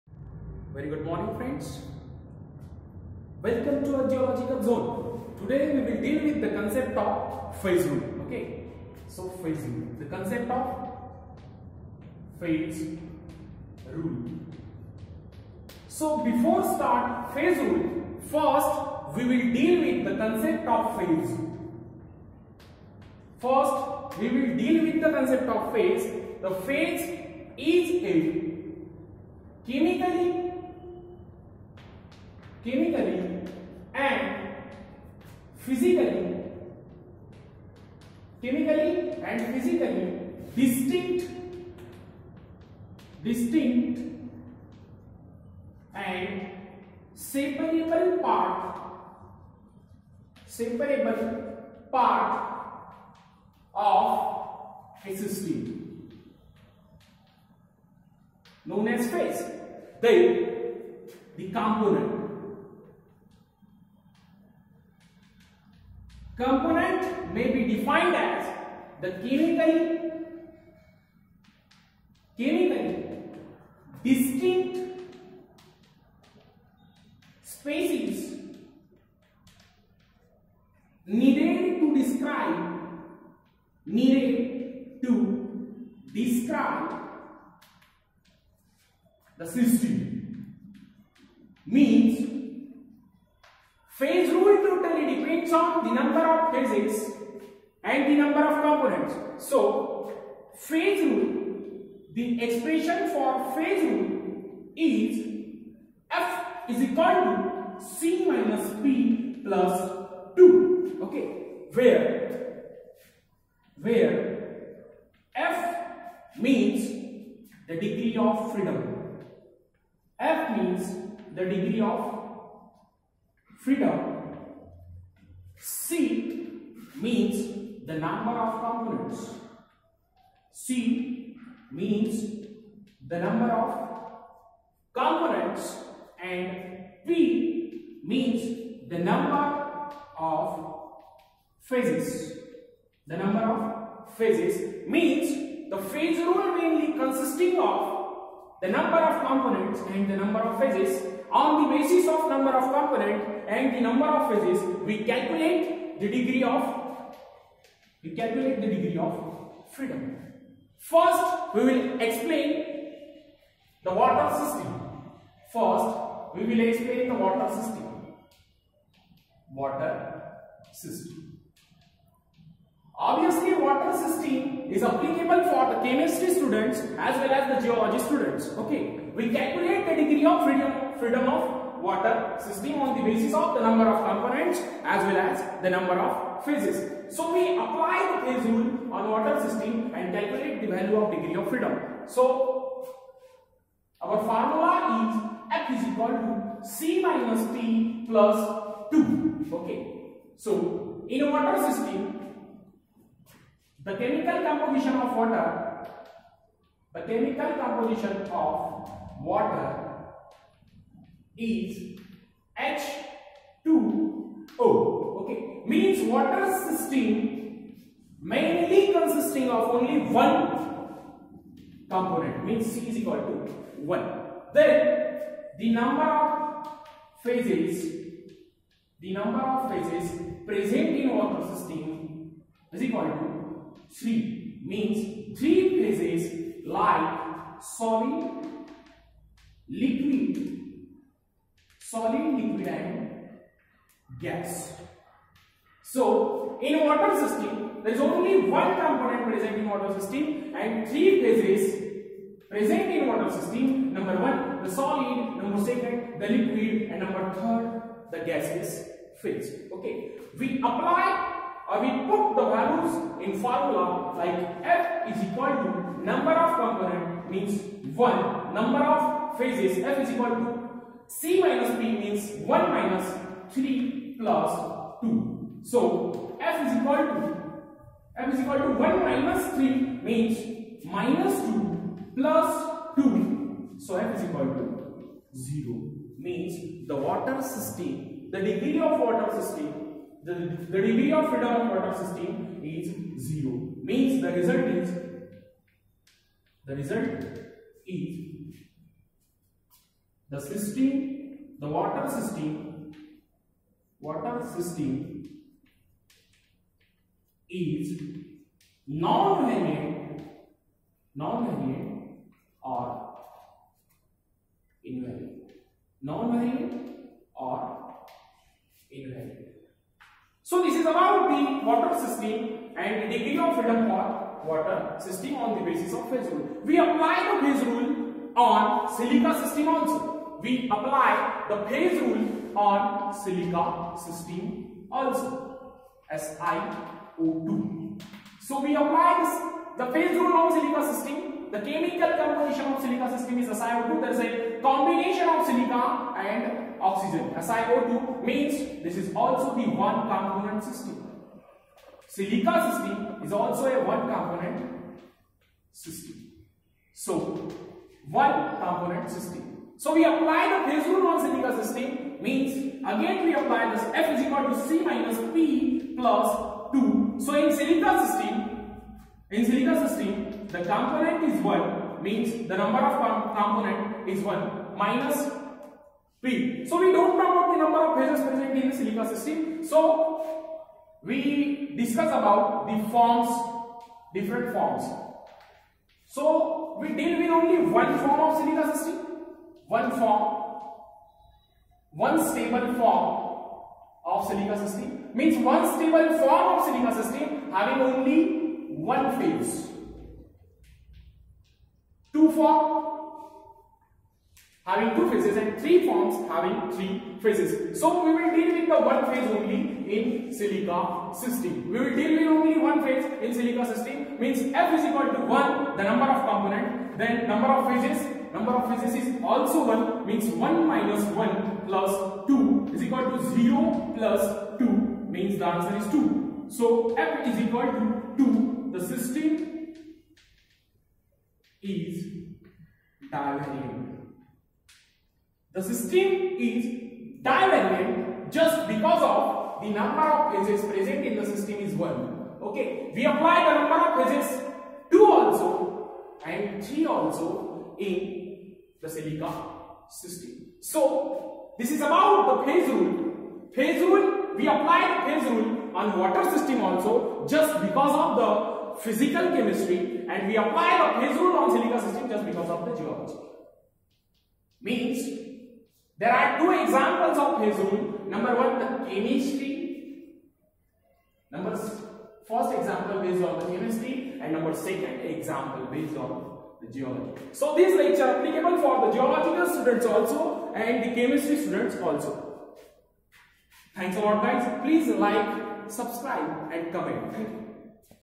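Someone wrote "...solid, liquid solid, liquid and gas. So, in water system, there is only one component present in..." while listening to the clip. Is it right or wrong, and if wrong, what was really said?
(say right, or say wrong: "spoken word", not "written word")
right.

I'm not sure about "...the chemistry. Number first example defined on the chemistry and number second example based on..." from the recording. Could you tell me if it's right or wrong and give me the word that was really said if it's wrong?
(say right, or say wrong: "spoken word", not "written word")
wrong: "based", not "defined".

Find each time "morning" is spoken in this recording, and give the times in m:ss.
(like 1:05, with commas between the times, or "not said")
0:01.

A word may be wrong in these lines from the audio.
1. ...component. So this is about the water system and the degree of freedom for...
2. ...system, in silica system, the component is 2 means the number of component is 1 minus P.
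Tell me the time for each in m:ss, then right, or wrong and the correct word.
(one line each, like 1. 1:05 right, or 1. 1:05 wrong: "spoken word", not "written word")
1. 5:18 wrong: "invariant", not "component"
2. 6:08 wrong: "1", not "2".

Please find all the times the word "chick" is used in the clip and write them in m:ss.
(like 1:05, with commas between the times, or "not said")
not said.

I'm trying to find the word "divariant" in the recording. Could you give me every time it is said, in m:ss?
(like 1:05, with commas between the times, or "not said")
7:13, 7:17.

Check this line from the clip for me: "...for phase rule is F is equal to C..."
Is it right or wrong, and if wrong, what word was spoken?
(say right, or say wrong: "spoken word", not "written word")
right.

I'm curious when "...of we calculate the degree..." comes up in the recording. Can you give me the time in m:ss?
2:36.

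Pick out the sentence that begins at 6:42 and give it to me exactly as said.
Two form having two phases and three forms having three phases.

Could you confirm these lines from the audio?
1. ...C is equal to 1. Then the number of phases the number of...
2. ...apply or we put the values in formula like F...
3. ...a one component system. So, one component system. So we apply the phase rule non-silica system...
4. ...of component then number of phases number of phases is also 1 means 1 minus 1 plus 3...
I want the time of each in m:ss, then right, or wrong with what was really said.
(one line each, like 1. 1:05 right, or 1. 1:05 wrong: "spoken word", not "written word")
1. 3:42 right
2. 4:20 right
3. 5:53 right
4. 6:56 wrong: "2", not "3".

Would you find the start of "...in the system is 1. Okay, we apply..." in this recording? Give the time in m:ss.
7:21.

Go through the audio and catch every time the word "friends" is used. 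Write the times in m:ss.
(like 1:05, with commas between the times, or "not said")
0:01.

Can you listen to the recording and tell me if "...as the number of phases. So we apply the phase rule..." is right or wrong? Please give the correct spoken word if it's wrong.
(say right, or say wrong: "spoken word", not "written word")
right.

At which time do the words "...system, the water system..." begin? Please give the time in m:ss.
5:00.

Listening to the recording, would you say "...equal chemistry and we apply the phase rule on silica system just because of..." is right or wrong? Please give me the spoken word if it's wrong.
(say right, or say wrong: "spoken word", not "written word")
wrong: "physical", not "equal".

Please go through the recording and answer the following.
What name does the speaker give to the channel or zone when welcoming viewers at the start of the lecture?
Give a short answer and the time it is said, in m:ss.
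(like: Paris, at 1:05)
Earth Geological Zone, at 0:03.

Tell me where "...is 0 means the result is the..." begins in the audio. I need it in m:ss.
4:52.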